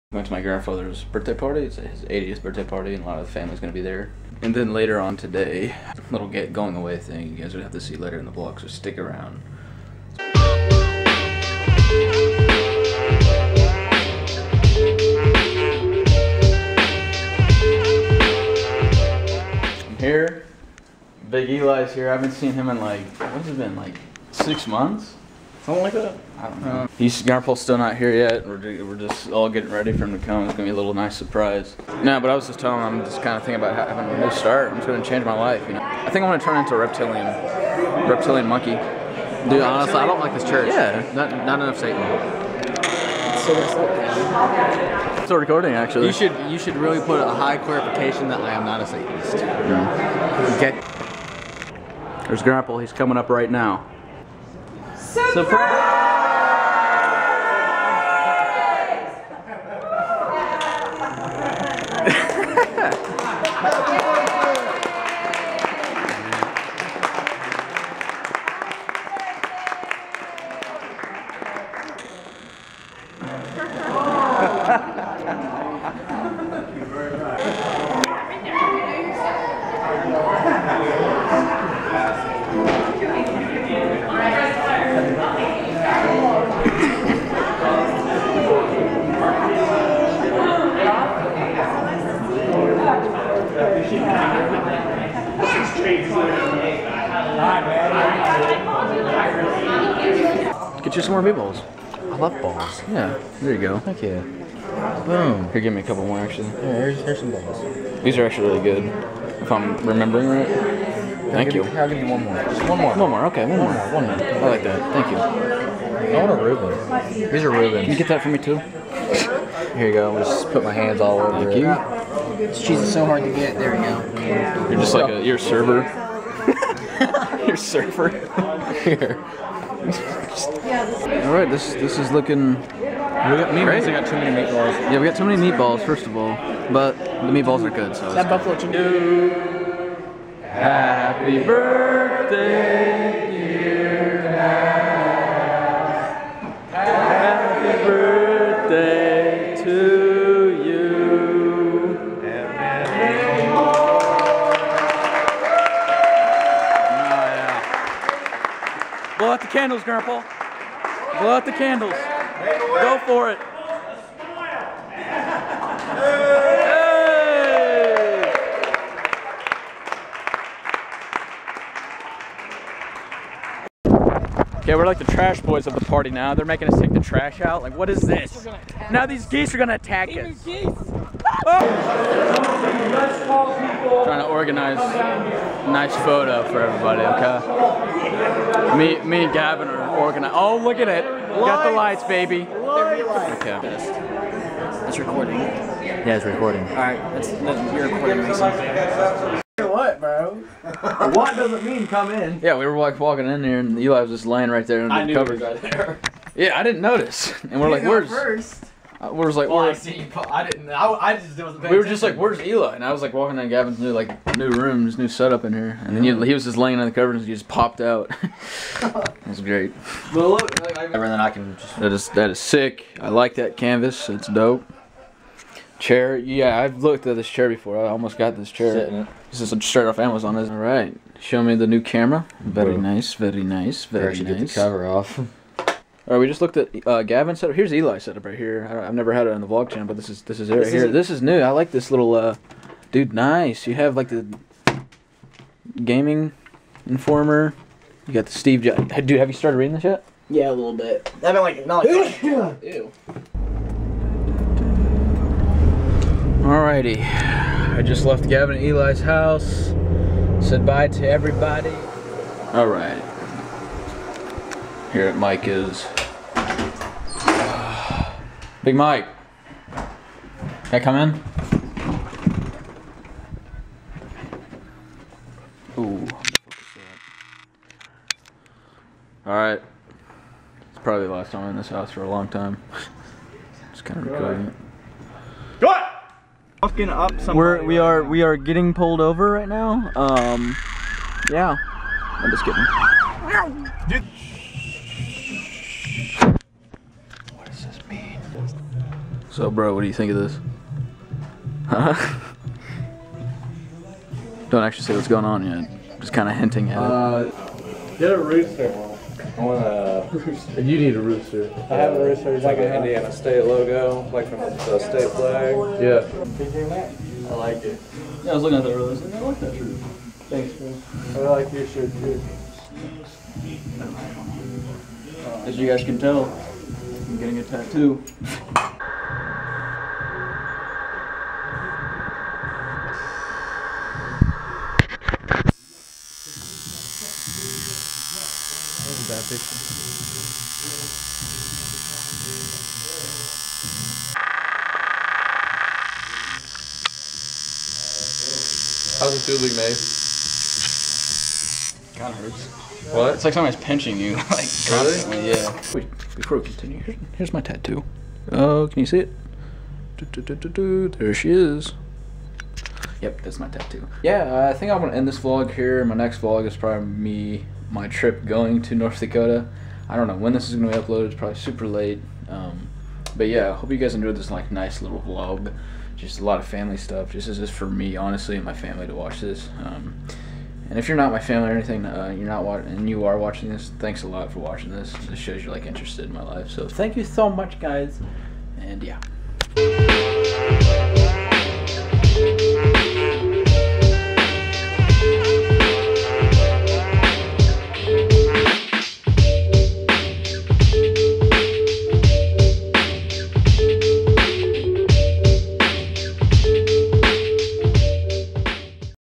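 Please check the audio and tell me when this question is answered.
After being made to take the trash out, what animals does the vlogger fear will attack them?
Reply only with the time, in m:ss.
2:59.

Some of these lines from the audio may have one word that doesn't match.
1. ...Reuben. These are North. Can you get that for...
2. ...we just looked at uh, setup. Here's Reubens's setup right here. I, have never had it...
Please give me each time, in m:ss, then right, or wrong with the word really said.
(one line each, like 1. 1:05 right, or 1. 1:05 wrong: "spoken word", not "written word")
1. 1:56 wrong: "Reubens", not "North"
2. 3:56 wrong: "Eli", not "Reubens".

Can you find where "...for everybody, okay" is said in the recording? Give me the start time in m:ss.
3:06.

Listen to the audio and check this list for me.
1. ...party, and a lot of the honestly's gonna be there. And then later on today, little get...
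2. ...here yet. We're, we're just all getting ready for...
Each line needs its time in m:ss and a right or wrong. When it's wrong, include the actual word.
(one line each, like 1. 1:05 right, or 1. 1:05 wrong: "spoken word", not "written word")
1. 0:02 wrong: "family", not "honestly"
2. 0:27 right.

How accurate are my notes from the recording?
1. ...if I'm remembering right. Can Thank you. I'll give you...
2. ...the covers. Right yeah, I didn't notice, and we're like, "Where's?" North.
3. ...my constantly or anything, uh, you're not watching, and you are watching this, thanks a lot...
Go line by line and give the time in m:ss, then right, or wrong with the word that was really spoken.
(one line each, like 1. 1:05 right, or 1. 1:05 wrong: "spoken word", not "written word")
1. 1:49 right
2. 3:25 wrong: "First", not "North"
3. 6:21 wrong: "family", not "constantly".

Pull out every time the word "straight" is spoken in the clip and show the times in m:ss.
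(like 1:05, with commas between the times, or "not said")
3:49.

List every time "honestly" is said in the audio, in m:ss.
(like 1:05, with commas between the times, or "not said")
0:39, 6:17.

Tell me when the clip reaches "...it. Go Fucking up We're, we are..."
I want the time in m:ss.
4:44.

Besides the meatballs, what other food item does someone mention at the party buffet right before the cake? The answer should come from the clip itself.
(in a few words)
Buffalo chicken.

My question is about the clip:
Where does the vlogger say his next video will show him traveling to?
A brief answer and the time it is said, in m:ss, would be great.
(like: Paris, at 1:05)
North Dakota, at 6:08.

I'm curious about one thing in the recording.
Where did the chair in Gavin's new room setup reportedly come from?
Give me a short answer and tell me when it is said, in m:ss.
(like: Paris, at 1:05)
Amazon, at 3:49.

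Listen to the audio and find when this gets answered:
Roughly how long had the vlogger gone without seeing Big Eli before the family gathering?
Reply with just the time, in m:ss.
0:24.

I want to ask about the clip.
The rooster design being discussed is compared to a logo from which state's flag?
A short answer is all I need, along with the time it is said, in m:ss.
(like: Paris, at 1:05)
Indiana, at 5:12.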